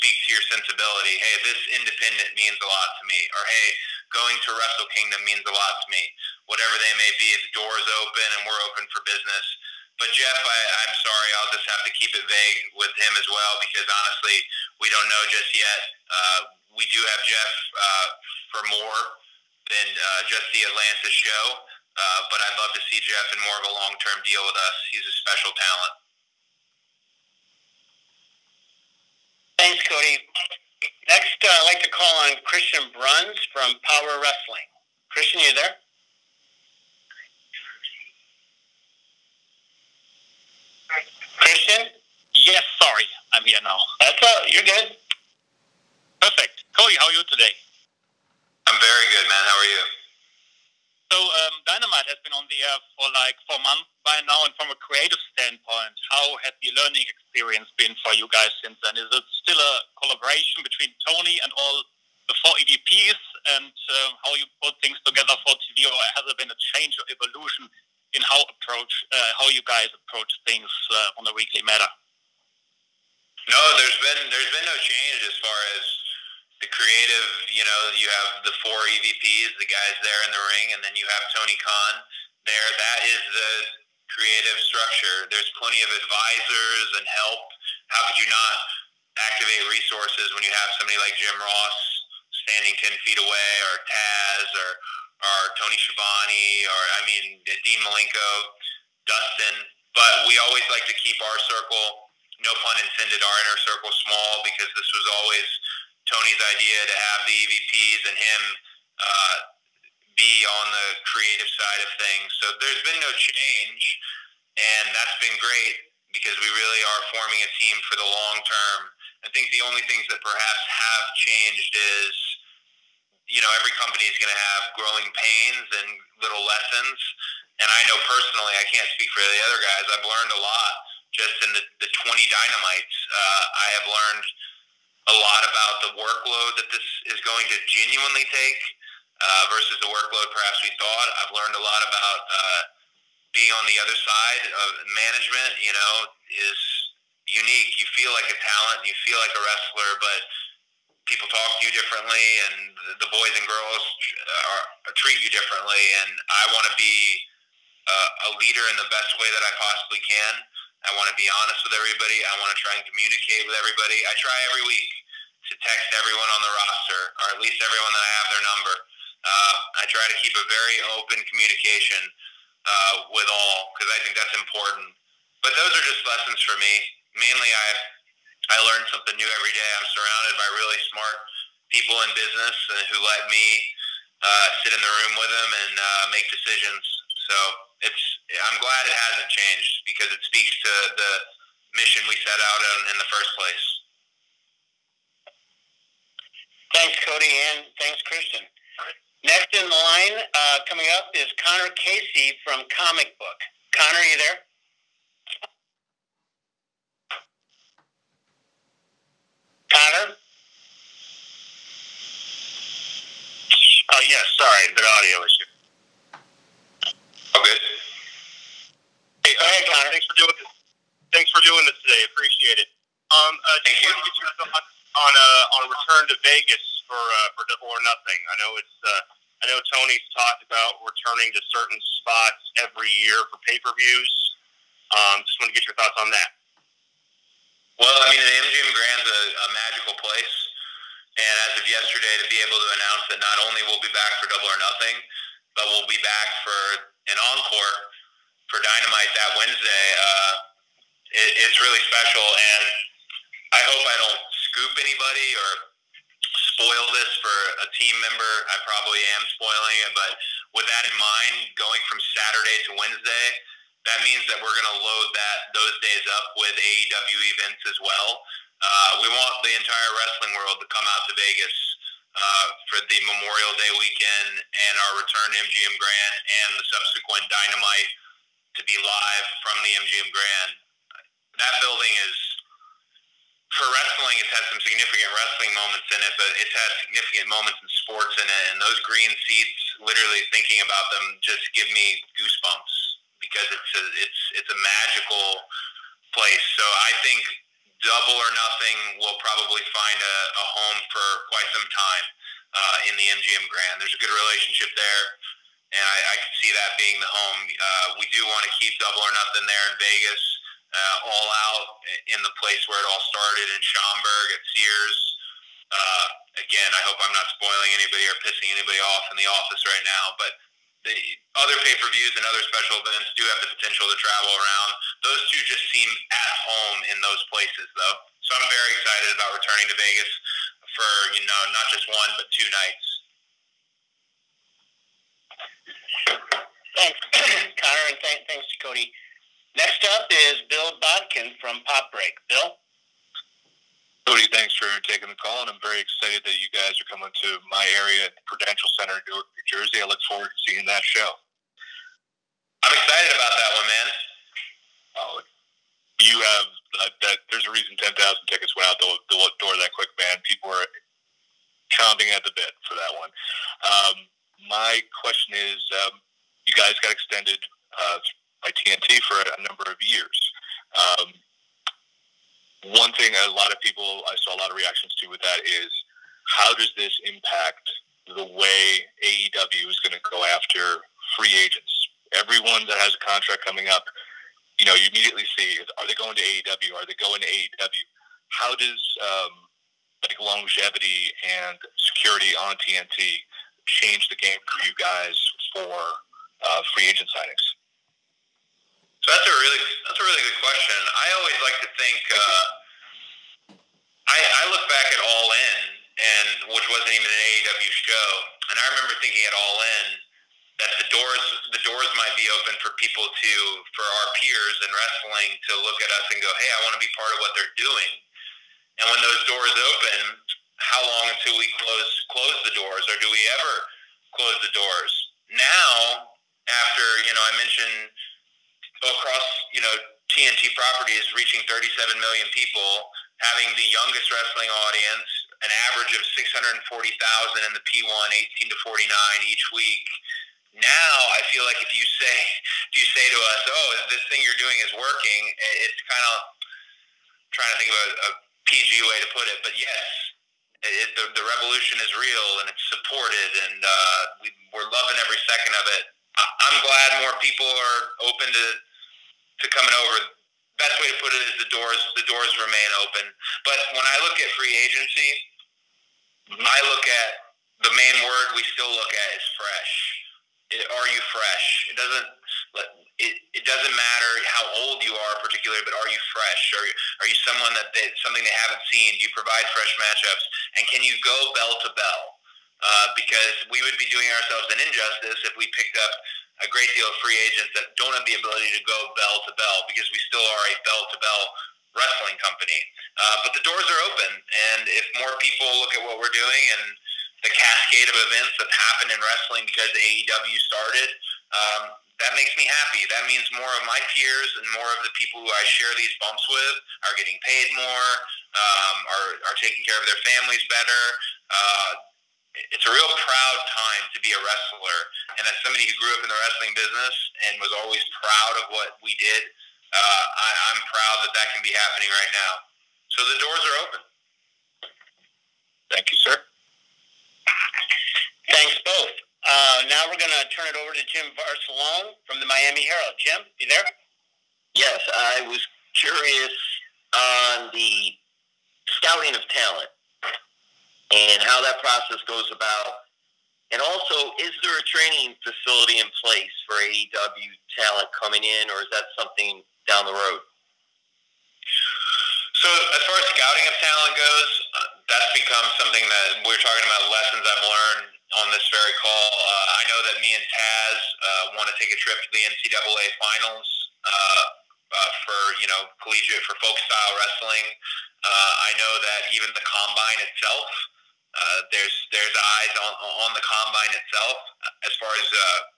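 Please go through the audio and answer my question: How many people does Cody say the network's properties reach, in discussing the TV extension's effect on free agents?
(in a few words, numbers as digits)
37 million.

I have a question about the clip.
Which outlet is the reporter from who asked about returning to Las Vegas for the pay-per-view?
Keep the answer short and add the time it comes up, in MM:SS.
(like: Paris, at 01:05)
Comic Book, at 03:22.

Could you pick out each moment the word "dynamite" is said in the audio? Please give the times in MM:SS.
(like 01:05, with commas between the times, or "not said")
00:51, 02:12, 04:08, 04:37.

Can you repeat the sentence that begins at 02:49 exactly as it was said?
Uh, I try to keep a very open communication uh, with all because I think that's important.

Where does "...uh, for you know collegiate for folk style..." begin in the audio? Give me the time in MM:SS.
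09:24.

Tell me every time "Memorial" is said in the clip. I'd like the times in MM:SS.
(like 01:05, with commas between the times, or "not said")
04:33.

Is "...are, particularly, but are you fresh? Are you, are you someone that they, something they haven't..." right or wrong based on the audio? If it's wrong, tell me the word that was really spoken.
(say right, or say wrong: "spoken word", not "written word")
right.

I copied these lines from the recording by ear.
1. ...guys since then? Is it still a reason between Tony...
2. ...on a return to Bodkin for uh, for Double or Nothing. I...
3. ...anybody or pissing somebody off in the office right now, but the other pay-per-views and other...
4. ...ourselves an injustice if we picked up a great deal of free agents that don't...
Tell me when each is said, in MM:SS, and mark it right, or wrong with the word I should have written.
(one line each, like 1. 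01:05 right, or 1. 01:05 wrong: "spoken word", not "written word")
1. 00:58 wrong: "collaboration", not "reason"
2. 03:45 wrong: "Vegas", not "Bodkin"
3. 05:17 wrong: "anybody", not "somebody"
4. 08:04 right.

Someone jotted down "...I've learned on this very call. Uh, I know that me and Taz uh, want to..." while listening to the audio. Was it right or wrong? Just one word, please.
right.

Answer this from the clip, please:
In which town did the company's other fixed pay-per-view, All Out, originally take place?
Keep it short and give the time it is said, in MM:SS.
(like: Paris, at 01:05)
Schaumburg, at 05:13.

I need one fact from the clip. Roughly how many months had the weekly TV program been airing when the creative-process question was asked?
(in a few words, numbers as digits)
4.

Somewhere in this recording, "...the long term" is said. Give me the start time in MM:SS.
01:57.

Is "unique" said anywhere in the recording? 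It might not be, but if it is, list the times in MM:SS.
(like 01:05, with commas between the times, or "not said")
02:27.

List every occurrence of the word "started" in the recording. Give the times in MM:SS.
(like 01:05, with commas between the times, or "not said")
05:13, 08:20.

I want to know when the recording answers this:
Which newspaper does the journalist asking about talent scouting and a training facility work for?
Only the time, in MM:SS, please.
08:52.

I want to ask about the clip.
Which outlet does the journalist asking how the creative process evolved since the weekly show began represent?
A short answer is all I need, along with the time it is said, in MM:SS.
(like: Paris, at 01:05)
Power Wrestling, at 00:33.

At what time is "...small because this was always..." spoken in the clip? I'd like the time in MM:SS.
01:43.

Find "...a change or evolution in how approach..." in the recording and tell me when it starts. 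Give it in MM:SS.
01:06.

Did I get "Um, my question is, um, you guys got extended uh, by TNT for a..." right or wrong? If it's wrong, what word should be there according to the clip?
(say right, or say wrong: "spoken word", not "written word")
right.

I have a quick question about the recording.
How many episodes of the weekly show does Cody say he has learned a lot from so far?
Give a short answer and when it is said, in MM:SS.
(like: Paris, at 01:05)
20, at 02:12.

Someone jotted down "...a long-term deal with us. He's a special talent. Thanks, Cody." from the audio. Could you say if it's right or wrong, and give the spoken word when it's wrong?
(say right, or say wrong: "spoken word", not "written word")
right.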